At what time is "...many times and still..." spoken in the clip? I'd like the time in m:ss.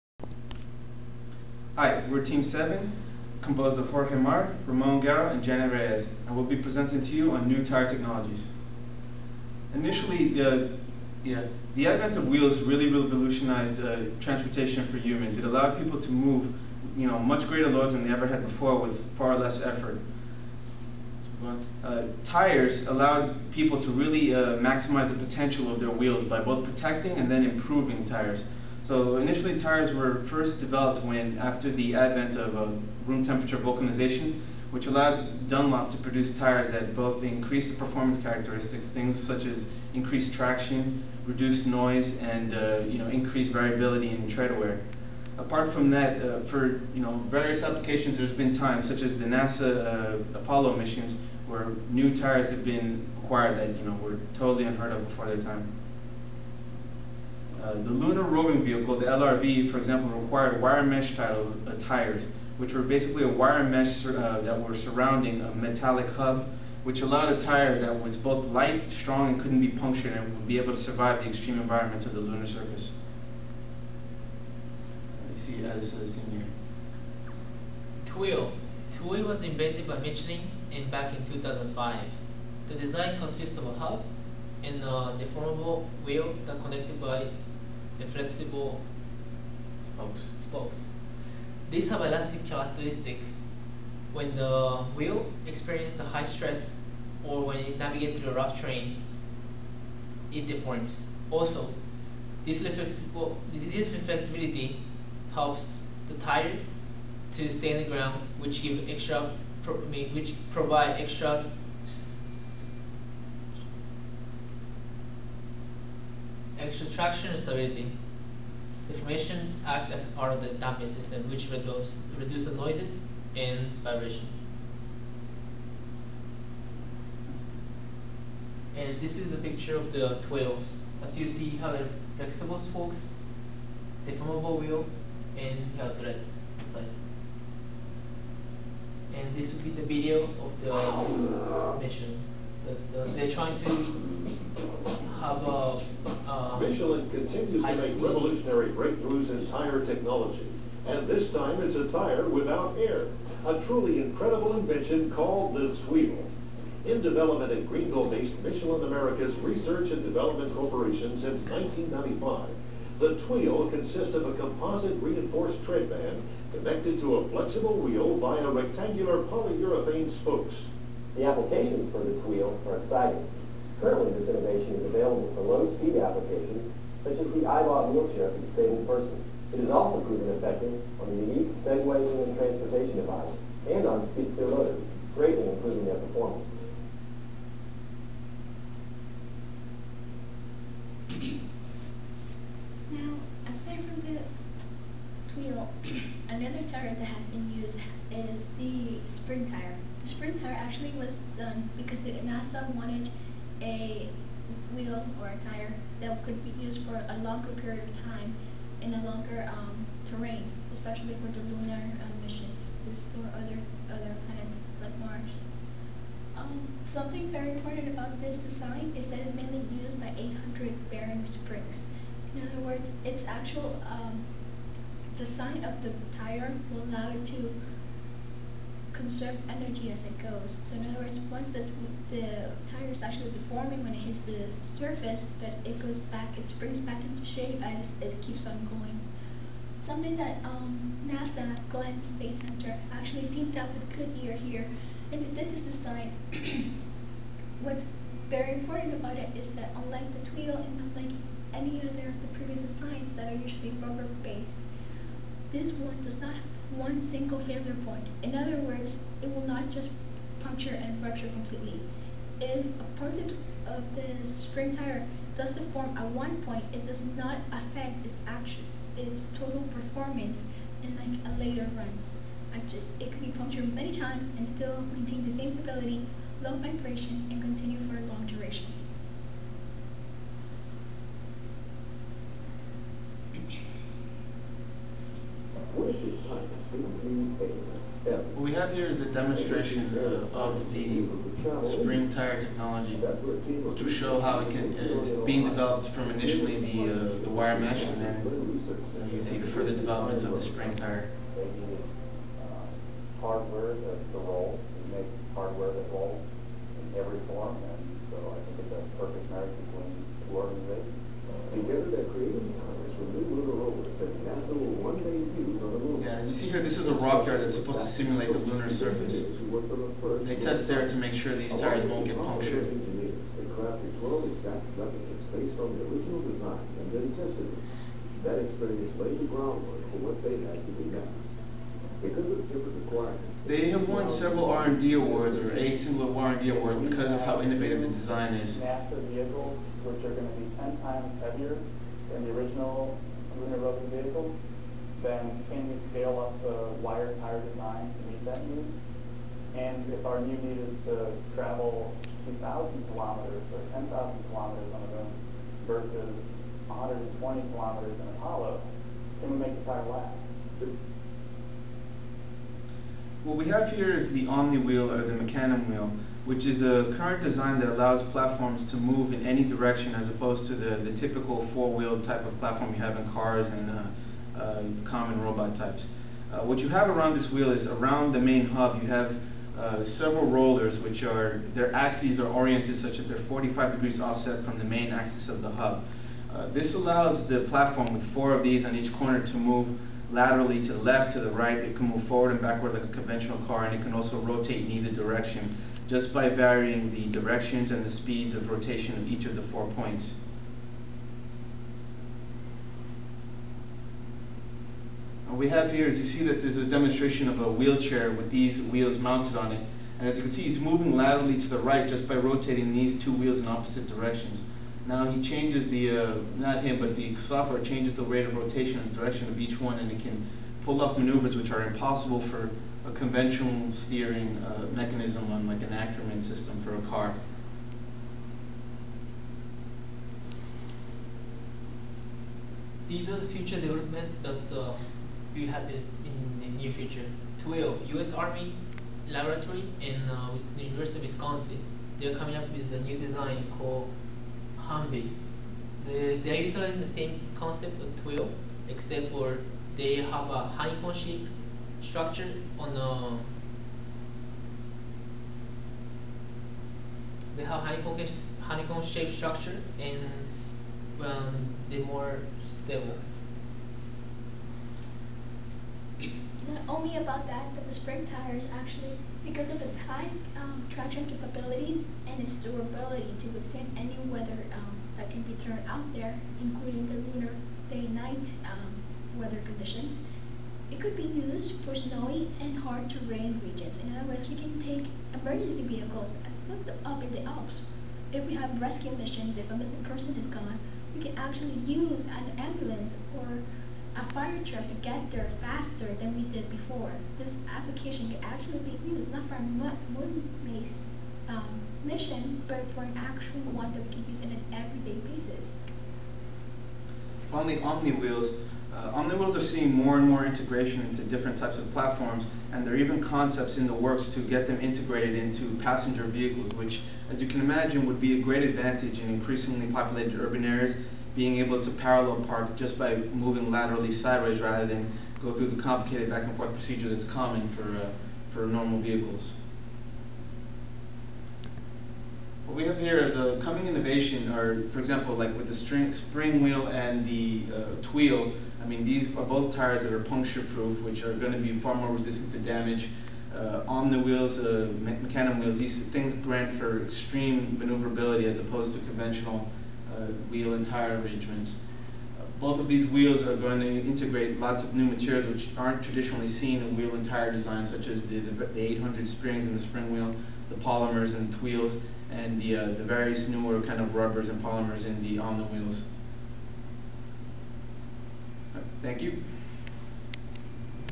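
4:33.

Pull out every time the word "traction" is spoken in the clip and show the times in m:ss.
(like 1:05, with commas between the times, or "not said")
0:40, 1:56, 7:50.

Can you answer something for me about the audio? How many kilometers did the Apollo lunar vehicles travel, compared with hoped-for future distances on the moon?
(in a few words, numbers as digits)
120 kilometers.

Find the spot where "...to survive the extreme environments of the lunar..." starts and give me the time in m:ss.
1:10.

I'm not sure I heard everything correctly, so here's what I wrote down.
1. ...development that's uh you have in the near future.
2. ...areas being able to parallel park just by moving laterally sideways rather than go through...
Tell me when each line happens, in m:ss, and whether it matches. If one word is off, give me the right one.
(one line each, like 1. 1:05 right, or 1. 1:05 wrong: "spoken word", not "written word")
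1. 7:13 right
2. 8:40 right.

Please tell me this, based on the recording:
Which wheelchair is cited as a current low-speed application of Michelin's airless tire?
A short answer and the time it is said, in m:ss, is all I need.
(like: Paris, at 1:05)
iBot, at 2:57.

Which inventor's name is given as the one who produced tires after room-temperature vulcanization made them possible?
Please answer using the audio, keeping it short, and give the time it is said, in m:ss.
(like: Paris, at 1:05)
Dunlop, at 0:35.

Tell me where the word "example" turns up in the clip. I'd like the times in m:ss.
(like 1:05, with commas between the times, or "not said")
0:59, 8:54.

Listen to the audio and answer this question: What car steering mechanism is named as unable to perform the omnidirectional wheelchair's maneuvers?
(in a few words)
Ackermann system.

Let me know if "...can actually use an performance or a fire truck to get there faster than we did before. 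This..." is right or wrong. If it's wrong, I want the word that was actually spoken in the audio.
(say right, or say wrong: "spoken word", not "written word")
wrong: "ambulance", not "performance".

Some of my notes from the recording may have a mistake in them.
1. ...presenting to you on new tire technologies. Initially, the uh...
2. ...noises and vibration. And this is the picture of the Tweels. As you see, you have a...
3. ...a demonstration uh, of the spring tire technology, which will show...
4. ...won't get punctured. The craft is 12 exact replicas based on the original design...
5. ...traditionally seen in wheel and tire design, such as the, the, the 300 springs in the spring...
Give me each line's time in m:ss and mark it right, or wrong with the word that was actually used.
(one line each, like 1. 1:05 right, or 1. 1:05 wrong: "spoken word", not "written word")
1. 0:06 right
2. 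2:02 right
3. 4:49 right
4. 5:21 right
5. 9:15 wrong: "800", not "300".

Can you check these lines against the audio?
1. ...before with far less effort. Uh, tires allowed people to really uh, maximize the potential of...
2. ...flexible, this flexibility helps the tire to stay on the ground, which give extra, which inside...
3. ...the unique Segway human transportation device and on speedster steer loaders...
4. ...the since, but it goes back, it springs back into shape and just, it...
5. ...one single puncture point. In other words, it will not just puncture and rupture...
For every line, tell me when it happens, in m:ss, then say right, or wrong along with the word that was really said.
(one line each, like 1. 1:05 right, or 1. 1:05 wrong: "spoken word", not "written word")
1. 0:18 right
2. 1:42 wrong: "provide", not "inside"
3. 3:01 right
4. 3:54 wrong: "surface", not "since"
5. 4:16 wrong: "failure", not "puncture".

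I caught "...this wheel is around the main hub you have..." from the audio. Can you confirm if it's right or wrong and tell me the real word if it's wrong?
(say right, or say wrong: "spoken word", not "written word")
right.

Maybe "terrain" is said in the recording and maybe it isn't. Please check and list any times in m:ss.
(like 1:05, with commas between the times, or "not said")
1:38, 3:30, 8:02.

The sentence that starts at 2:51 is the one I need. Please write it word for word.
The applications for the Tweel are exciting.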